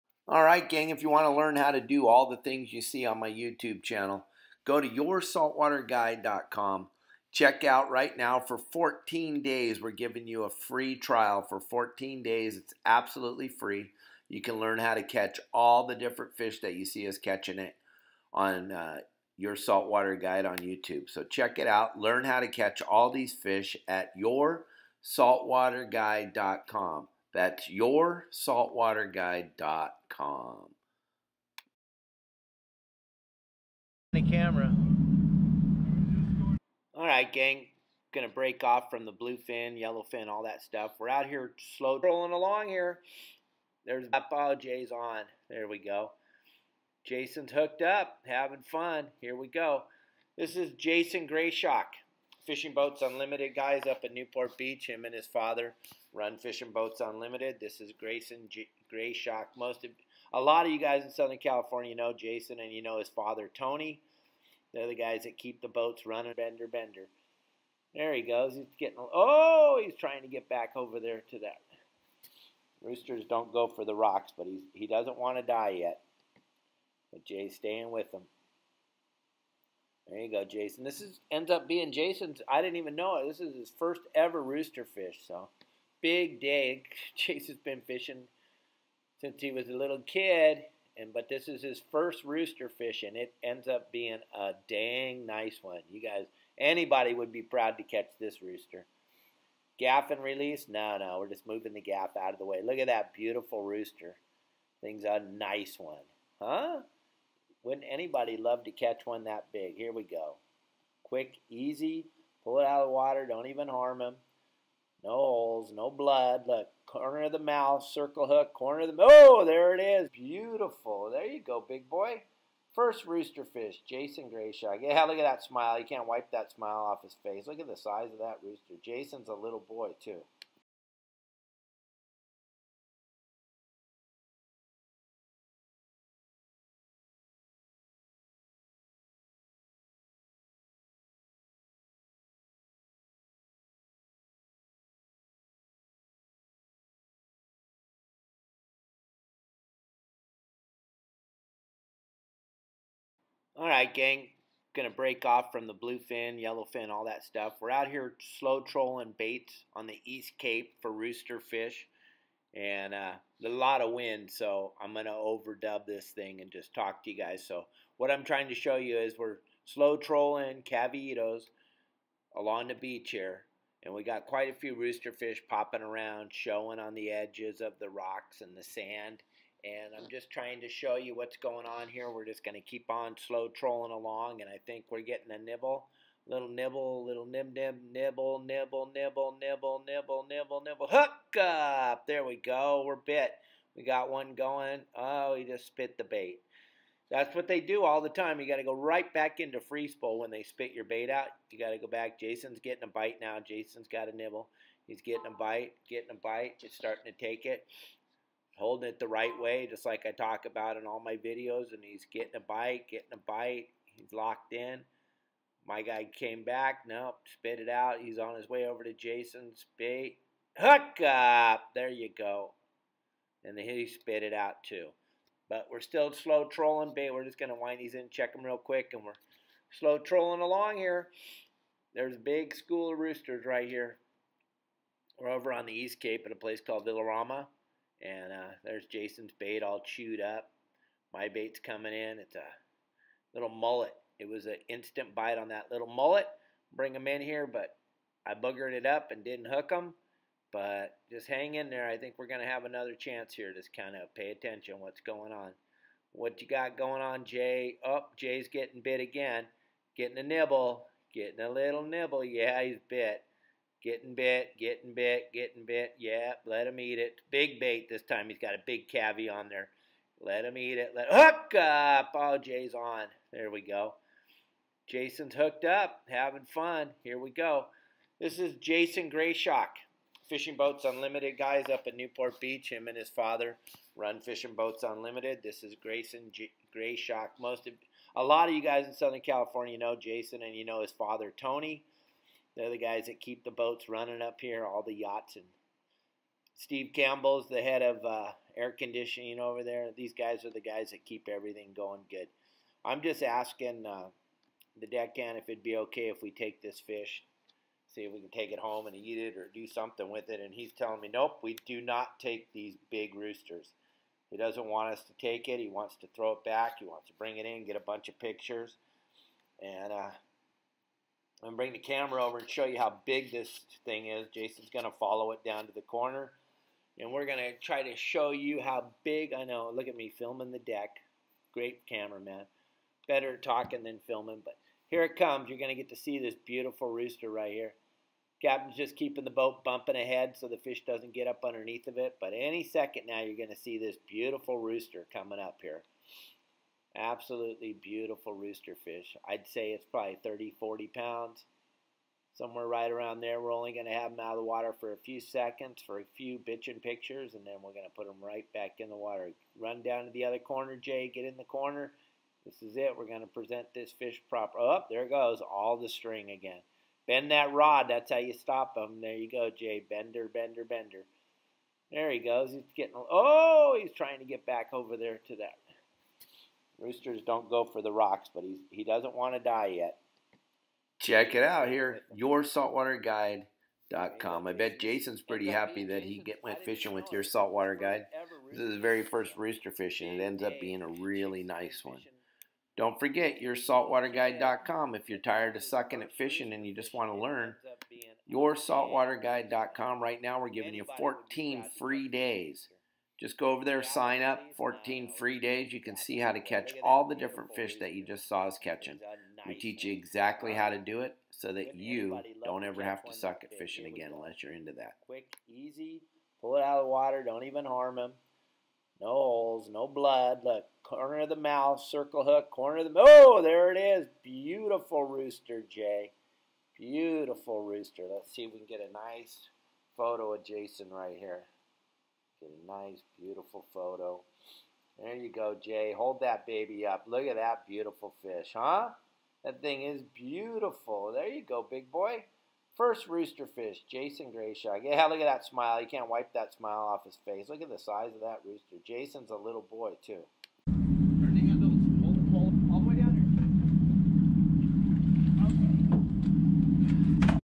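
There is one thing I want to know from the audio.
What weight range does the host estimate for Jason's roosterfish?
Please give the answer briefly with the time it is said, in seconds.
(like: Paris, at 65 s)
30 to 40 pounds, at 350 s.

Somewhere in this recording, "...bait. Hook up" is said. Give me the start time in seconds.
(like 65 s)
219 s.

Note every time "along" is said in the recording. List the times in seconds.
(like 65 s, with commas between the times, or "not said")
42 s, 172 s, 183 s, 230 s.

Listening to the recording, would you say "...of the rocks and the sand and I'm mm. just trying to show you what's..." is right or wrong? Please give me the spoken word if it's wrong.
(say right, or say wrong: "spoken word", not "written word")
right.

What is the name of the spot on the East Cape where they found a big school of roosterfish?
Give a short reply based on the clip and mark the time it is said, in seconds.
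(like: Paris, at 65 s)
Villarama, at 236 s.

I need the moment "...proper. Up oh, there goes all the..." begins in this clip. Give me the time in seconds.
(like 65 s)
364 s.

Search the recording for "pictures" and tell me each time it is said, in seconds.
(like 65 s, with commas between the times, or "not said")
318 s, 356 s.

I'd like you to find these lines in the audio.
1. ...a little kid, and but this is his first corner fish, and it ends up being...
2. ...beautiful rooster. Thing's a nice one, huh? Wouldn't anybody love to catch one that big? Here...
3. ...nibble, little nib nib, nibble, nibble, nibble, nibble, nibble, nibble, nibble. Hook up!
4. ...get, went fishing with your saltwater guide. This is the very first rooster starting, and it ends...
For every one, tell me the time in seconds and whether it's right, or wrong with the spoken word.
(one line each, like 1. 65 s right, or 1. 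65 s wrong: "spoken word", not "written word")
1. 89 s wrong: "rooster", not "corner"
2. 103 s right
3. 186 s right
4. 386 s wrong: "fishing", not "starting".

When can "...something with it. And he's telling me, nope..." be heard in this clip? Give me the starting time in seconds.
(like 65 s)
309 s.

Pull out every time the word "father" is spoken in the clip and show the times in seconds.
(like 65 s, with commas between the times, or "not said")
55 s, 63 s, 283 s, 290 s.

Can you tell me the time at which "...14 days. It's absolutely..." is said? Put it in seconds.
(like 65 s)
11 s.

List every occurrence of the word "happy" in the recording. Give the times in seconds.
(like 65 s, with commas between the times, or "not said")
385 s.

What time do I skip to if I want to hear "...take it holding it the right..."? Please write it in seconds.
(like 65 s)
207 s.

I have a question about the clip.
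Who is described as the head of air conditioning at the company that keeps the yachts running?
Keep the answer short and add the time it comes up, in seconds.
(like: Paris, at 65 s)
Steve Campbell, at 296 s.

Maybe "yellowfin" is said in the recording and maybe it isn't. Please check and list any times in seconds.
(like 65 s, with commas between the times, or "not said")
39 s, 156 s.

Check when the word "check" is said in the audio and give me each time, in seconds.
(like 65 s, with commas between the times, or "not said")
7 s, 21 s, 228 s, 380 s.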